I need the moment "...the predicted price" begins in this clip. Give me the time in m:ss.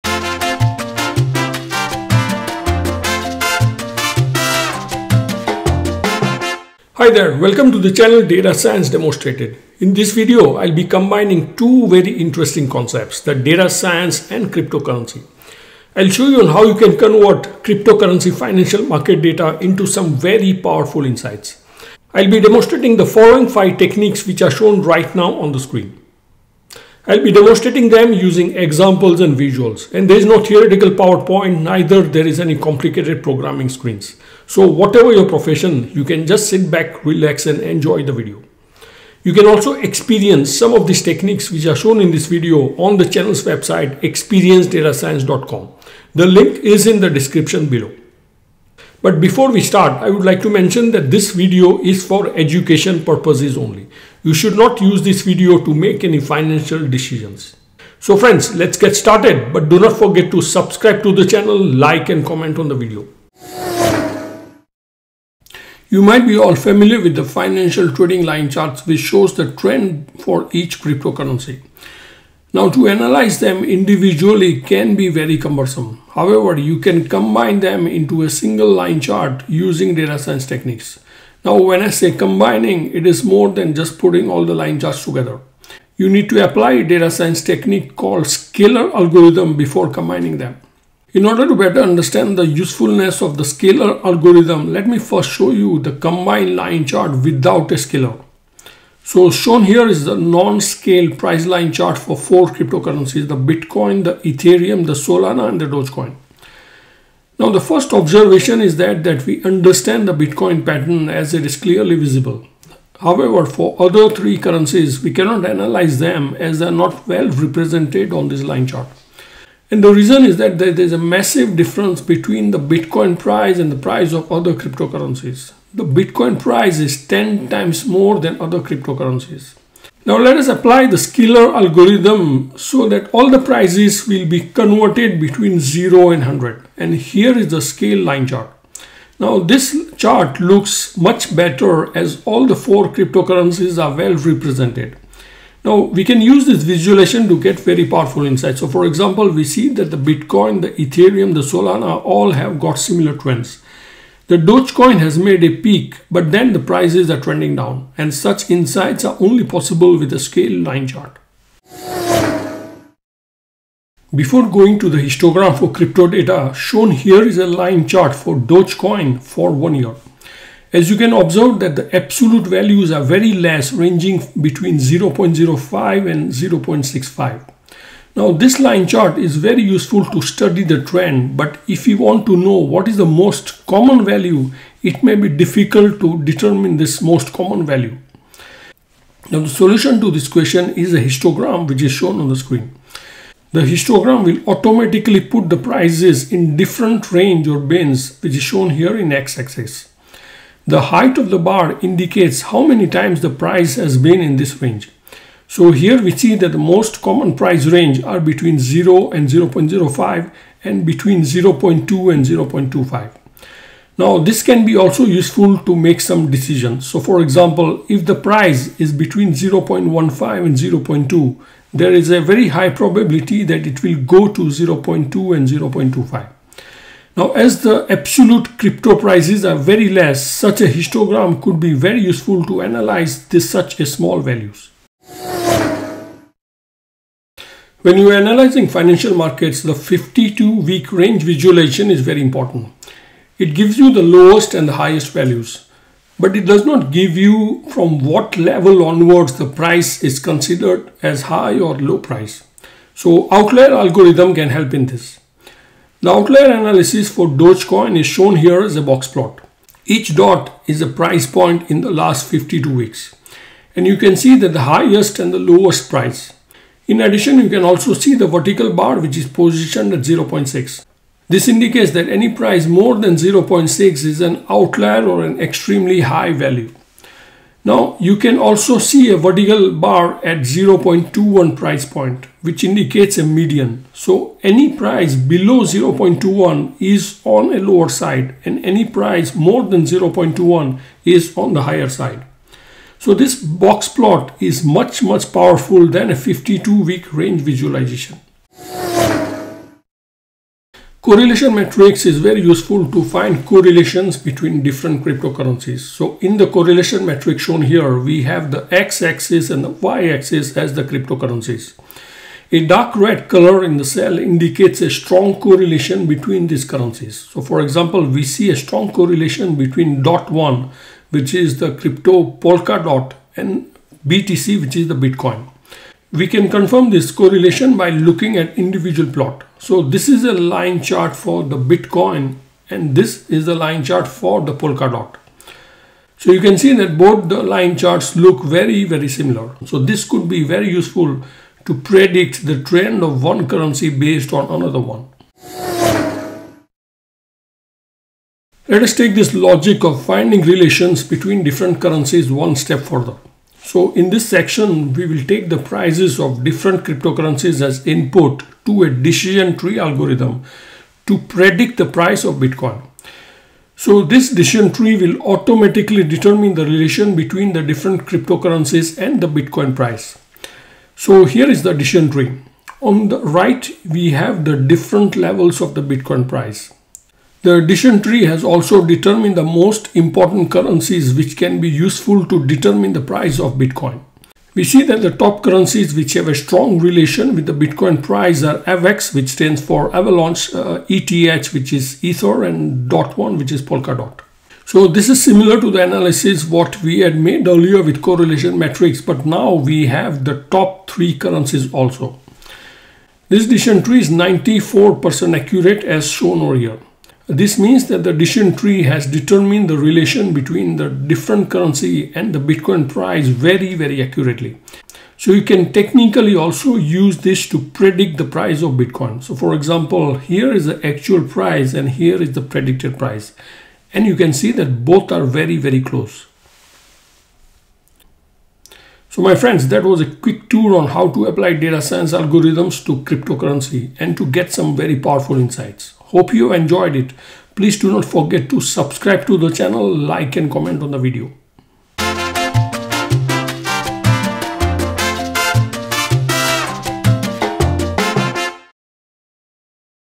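7:02.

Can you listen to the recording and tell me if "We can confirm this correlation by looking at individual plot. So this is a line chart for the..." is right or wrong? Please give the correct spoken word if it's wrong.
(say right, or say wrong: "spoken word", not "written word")
right.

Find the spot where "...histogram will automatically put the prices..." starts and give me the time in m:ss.
3:13.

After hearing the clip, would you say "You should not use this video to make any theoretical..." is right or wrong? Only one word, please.
wrong.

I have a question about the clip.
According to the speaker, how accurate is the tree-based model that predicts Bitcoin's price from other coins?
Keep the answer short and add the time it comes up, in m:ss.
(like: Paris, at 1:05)
94%, at 6:44.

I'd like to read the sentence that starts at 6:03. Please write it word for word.
So this decision tree will automatically determine the relation between the different cryptocurrencies and the Bitcoin price.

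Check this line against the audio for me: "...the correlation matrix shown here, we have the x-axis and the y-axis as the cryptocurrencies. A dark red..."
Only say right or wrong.
right.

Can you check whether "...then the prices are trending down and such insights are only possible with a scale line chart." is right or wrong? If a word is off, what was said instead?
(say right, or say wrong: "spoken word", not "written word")
right.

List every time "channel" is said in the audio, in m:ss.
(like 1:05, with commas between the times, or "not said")
0:07, 0:43, 1:01, 7:19.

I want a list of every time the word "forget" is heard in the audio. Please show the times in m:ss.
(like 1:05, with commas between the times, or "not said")
0:59, 7:18.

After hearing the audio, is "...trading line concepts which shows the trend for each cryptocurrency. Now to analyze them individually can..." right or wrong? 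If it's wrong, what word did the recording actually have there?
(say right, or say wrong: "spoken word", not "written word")
wrong: "charts", not "concepts".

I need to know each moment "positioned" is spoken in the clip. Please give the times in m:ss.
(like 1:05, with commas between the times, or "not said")
4:29.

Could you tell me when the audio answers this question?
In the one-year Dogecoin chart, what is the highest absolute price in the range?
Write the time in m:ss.
2:56.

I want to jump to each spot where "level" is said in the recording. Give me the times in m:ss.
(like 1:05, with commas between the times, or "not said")
4:08, 6:15.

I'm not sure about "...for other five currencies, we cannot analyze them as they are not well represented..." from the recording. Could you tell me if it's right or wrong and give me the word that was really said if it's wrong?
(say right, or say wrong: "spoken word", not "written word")
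wrong: "three", not "five".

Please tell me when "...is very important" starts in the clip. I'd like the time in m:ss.
4:01.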